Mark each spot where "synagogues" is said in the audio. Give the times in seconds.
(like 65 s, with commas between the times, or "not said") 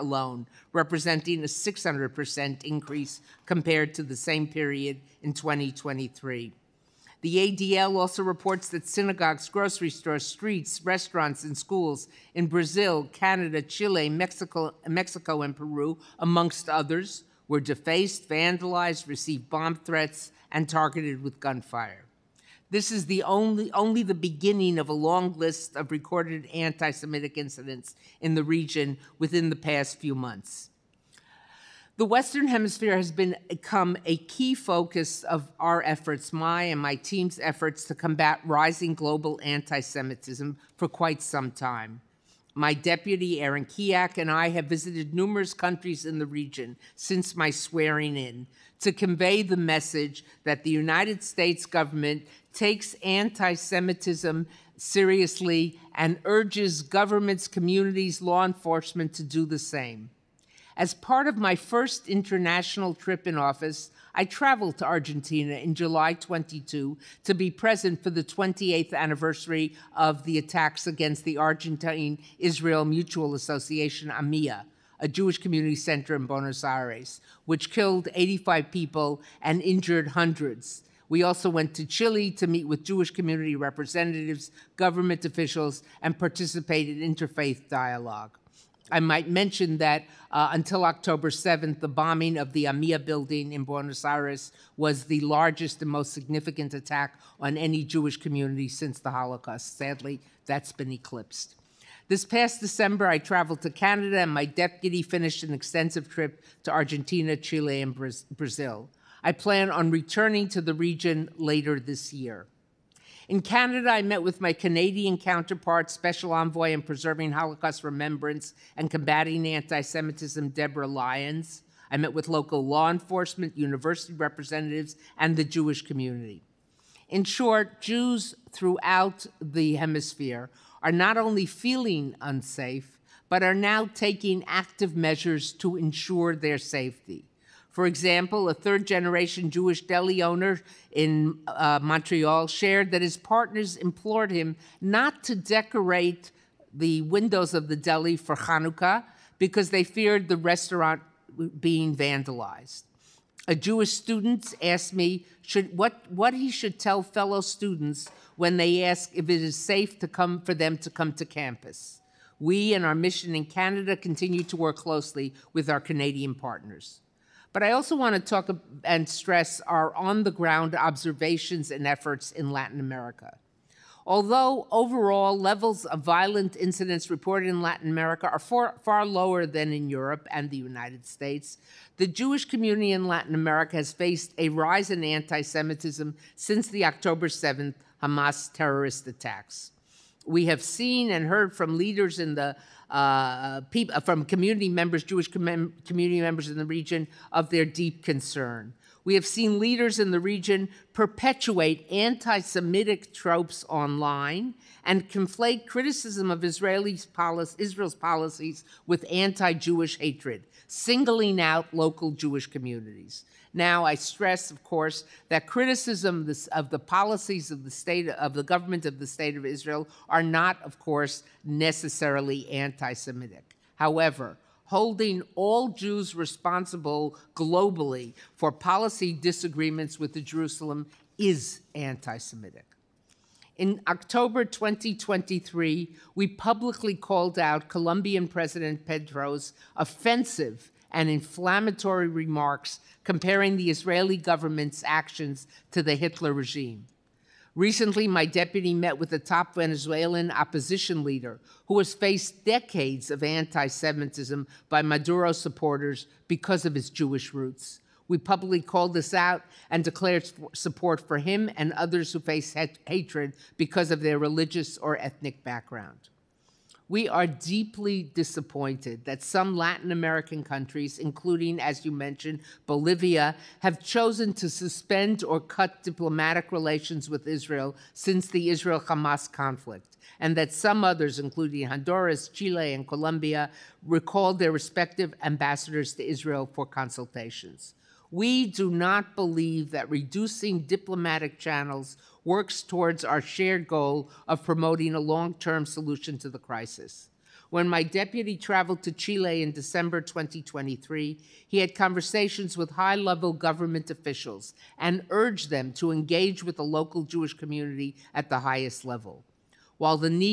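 8 s.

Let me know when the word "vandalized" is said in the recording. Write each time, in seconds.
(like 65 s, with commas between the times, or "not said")
18 s, 151 s.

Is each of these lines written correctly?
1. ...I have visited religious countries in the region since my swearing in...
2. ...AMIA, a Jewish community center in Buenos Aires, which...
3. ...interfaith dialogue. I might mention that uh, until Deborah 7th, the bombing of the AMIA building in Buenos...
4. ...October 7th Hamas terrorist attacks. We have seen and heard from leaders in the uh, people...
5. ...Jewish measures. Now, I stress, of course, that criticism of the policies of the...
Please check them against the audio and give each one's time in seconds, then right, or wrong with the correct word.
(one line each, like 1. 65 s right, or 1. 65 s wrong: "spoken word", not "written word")
1. 44 s wrong: "numerous", not "religious"
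2. 74 s right
3. 87 s wrong: "October", not "Deborah"
4. 186 s right
5. 212 s wrong: "communities", not "measures".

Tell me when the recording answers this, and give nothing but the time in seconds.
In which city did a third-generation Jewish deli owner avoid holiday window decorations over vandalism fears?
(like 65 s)
141 s.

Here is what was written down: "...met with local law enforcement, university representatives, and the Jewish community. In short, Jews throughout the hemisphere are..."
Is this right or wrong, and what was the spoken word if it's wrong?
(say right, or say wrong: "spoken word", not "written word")
right.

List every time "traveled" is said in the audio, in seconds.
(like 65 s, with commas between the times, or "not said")
64 s, 103 s, 298 s.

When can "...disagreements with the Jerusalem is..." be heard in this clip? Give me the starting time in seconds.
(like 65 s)
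229 s.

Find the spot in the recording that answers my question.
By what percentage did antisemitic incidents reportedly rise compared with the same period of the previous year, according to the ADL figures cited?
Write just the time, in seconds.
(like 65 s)
1 s.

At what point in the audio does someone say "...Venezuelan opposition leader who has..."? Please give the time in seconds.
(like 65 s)
249 s.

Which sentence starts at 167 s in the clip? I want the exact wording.
But I also want to talk and stress our on the ground observations and efforts in Latin America.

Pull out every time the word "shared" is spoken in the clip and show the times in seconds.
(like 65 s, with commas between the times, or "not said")
142 s, 293 s.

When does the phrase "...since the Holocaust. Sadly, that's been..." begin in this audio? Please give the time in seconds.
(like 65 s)
98 s.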